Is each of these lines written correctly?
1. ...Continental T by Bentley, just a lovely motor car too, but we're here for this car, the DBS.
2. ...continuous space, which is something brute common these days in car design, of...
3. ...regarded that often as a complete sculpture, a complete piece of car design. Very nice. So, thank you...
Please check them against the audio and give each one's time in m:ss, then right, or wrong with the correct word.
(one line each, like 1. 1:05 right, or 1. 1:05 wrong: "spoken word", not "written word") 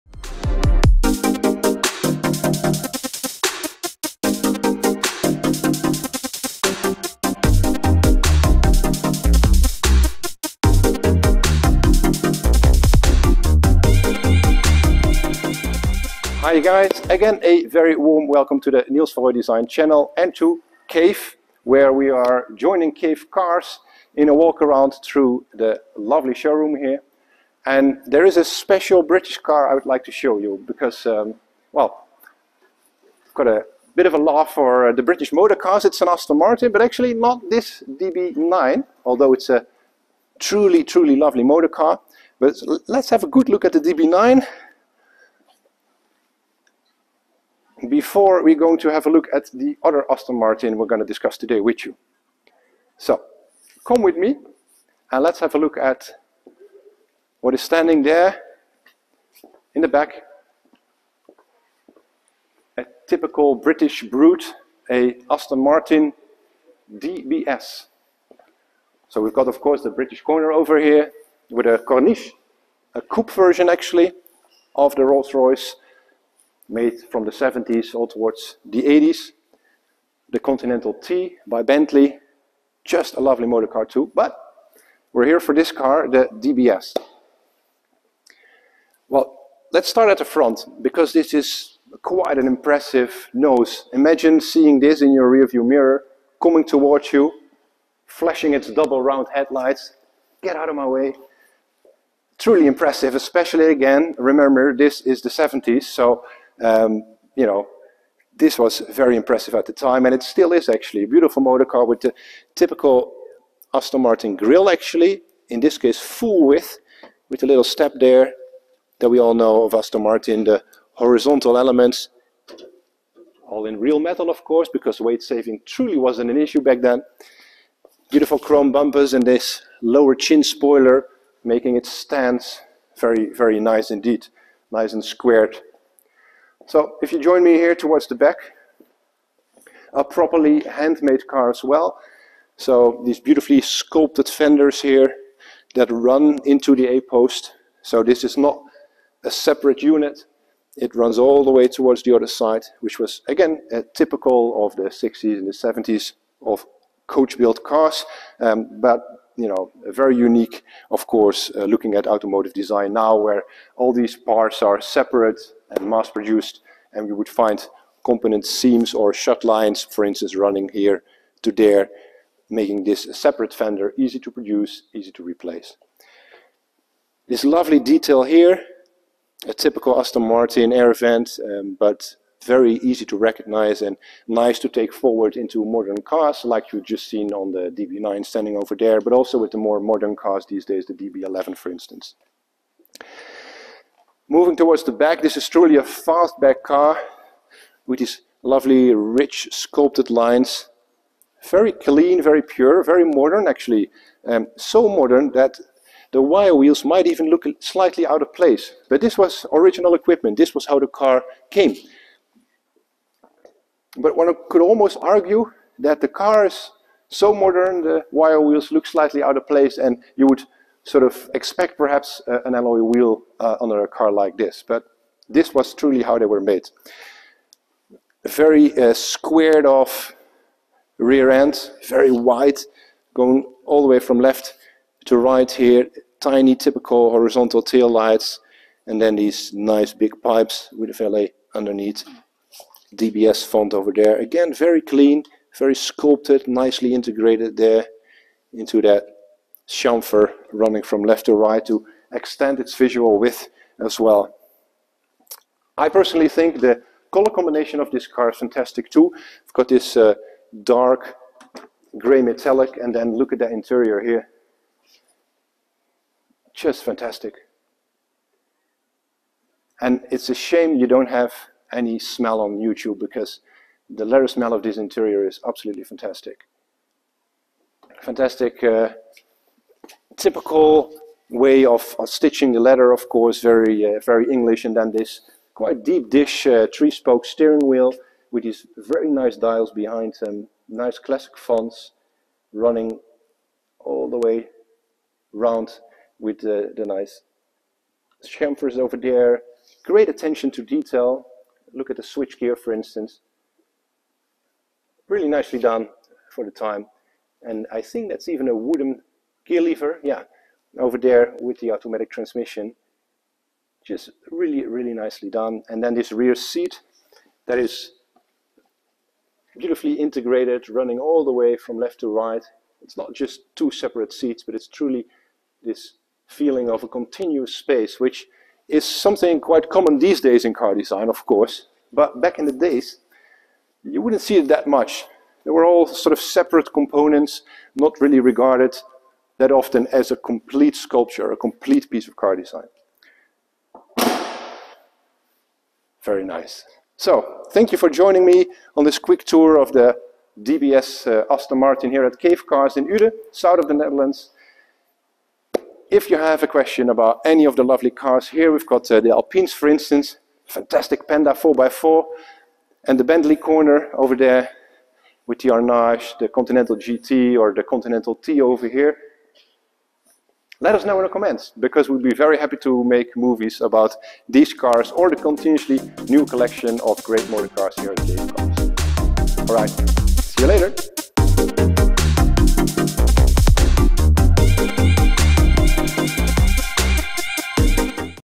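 1. 1:20 right
2. 5:26 wrong: "quite", not "brute"
3. 5:38 right.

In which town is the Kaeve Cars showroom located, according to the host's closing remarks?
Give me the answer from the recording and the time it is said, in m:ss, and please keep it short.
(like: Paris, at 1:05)
Uden, at 5:52.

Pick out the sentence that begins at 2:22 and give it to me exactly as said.
So these beautifully sculpted fenders here that run into the A-post.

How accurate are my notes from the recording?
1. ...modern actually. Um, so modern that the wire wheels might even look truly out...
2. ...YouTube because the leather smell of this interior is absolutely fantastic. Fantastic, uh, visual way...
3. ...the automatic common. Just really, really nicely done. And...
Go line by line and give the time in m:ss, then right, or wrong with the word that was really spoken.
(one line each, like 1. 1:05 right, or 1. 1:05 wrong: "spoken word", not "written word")
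1. 3:23 wrong: "slightly", not "truly"
2. 4:32 wrong: "typical", not "visual"
3. 5:11 wrong: "transmission", not "common".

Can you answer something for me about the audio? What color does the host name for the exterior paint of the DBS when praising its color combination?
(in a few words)
Dark gray metallic.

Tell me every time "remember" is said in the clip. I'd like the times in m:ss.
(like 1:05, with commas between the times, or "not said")
1:44.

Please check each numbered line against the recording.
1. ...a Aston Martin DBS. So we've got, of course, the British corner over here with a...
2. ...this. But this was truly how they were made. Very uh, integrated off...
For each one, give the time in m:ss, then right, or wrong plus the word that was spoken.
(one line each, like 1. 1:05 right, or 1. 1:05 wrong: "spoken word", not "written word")
1. 1:04 right
2. 3:44 wrong: "squared", not "integrated".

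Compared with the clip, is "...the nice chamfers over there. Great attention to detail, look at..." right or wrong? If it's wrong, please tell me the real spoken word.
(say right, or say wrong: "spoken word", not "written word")
right.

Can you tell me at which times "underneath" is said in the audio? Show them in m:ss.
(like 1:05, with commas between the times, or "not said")
4:01.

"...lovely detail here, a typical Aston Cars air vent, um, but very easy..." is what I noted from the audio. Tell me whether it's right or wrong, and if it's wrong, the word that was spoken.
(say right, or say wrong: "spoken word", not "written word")
wrong: "Martin", not "Cars".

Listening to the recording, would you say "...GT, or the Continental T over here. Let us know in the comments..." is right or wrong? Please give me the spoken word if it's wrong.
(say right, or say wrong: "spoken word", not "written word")
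right.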